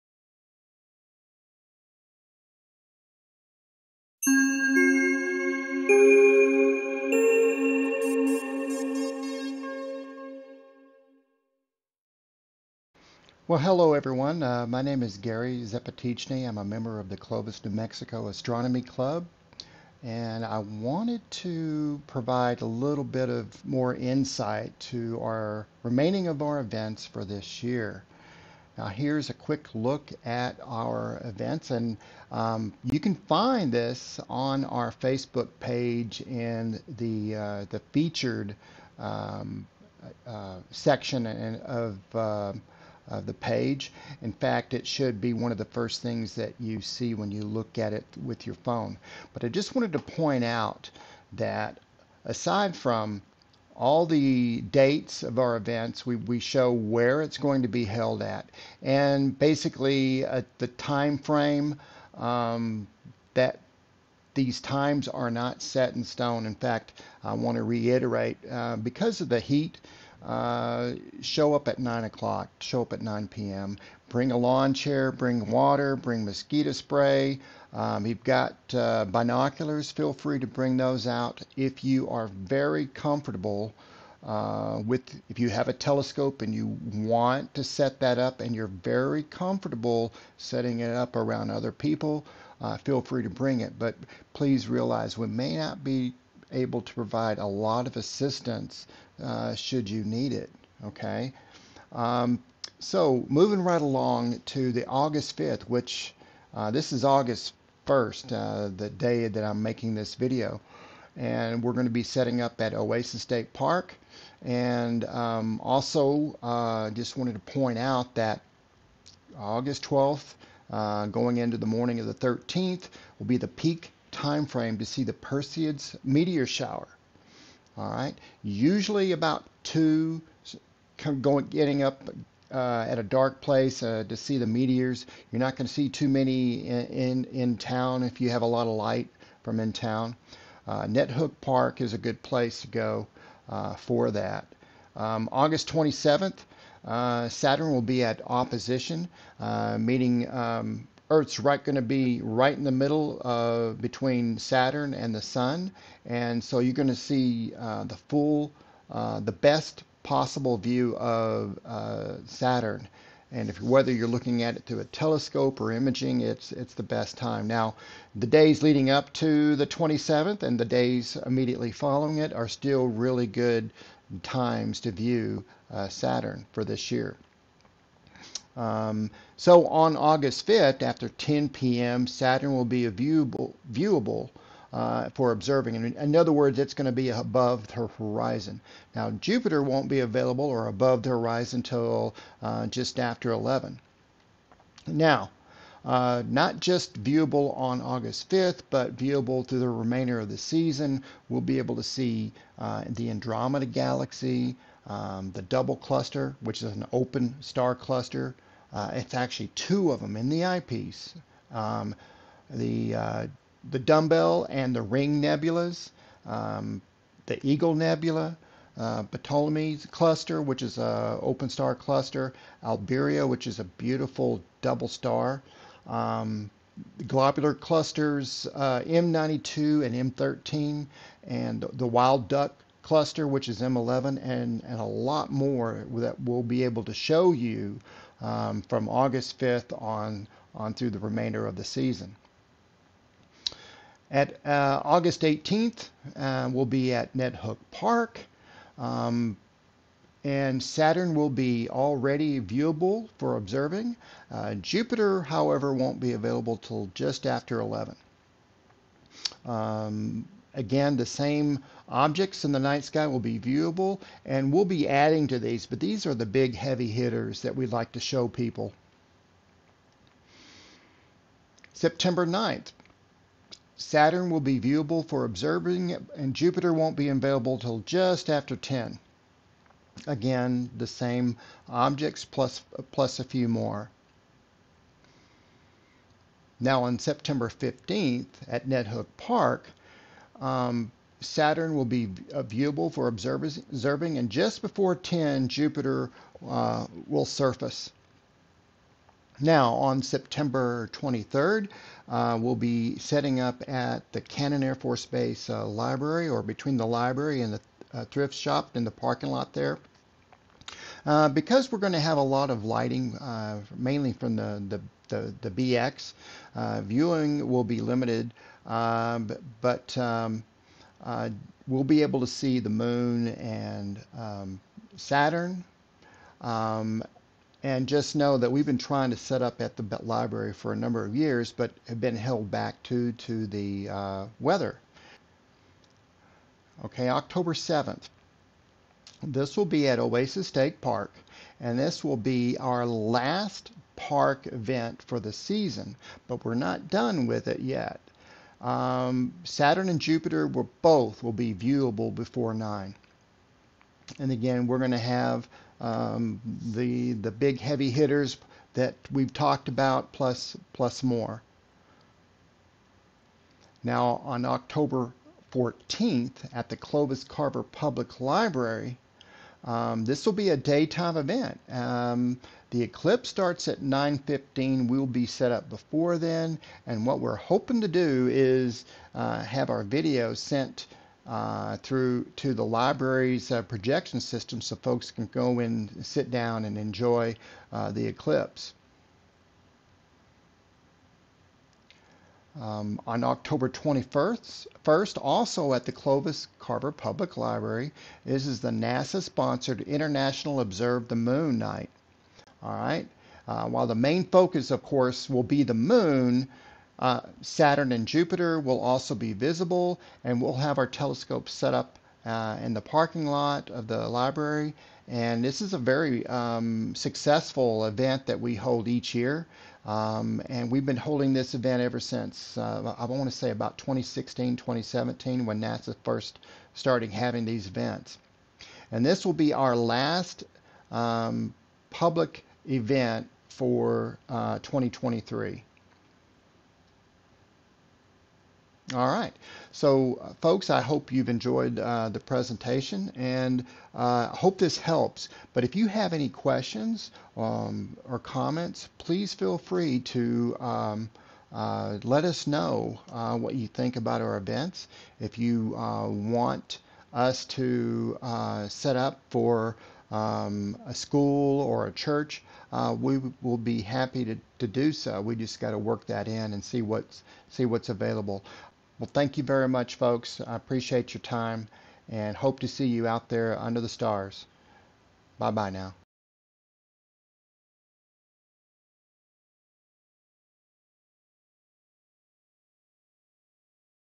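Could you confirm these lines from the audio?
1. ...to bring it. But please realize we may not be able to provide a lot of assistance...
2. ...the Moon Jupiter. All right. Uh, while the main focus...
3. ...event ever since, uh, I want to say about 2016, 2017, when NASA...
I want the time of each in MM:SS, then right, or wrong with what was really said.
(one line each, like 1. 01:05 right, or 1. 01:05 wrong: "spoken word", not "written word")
1. 01:33 right
2. 06:41 wrong: "Night", not "Jupiter"
3. 07:01 right.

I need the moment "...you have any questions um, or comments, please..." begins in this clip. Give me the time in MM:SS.
07:25.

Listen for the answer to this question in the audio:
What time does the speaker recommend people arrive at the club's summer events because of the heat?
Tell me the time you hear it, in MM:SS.
01:12.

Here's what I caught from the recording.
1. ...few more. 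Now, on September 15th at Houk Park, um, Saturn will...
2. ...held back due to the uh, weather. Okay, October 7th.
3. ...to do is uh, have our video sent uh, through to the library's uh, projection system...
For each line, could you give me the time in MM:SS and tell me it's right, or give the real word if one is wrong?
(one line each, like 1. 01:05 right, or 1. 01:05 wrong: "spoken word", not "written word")
1. 04:43 right
2. 05:32 right
3. 06:17 right.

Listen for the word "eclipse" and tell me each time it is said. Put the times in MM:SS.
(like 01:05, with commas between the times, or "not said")
06:12, 06:28.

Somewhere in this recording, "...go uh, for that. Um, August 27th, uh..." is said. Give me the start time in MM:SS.
02:22.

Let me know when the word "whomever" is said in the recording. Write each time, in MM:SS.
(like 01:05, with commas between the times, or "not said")
not said.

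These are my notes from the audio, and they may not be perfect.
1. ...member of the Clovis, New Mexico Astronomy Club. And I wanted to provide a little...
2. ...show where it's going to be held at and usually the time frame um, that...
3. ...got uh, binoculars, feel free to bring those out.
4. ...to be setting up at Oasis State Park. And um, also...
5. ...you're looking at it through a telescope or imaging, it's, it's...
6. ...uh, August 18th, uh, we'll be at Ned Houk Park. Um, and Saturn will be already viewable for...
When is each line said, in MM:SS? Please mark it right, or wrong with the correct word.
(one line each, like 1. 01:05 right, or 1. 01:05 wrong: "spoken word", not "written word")
1. 00:16 right
2. 00:56 wrong: "basically", not "usually"
3. 01:18 right
4. 01:51 right
5. 02:43 right
6. 04:04 right.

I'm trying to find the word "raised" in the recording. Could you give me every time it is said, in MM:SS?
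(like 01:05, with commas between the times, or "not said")
not said.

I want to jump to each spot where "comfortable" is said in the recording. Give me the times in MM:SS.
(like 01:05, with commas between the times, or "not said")
01:22, 01:29.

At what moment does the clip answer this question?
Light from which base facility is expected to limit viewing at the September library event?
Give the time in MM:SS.
05:15.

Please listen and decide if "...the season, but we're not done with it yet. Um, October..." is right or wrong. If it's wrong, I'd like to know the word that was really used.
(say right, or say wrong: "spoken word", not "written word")
wrong: "Saturn", not "October".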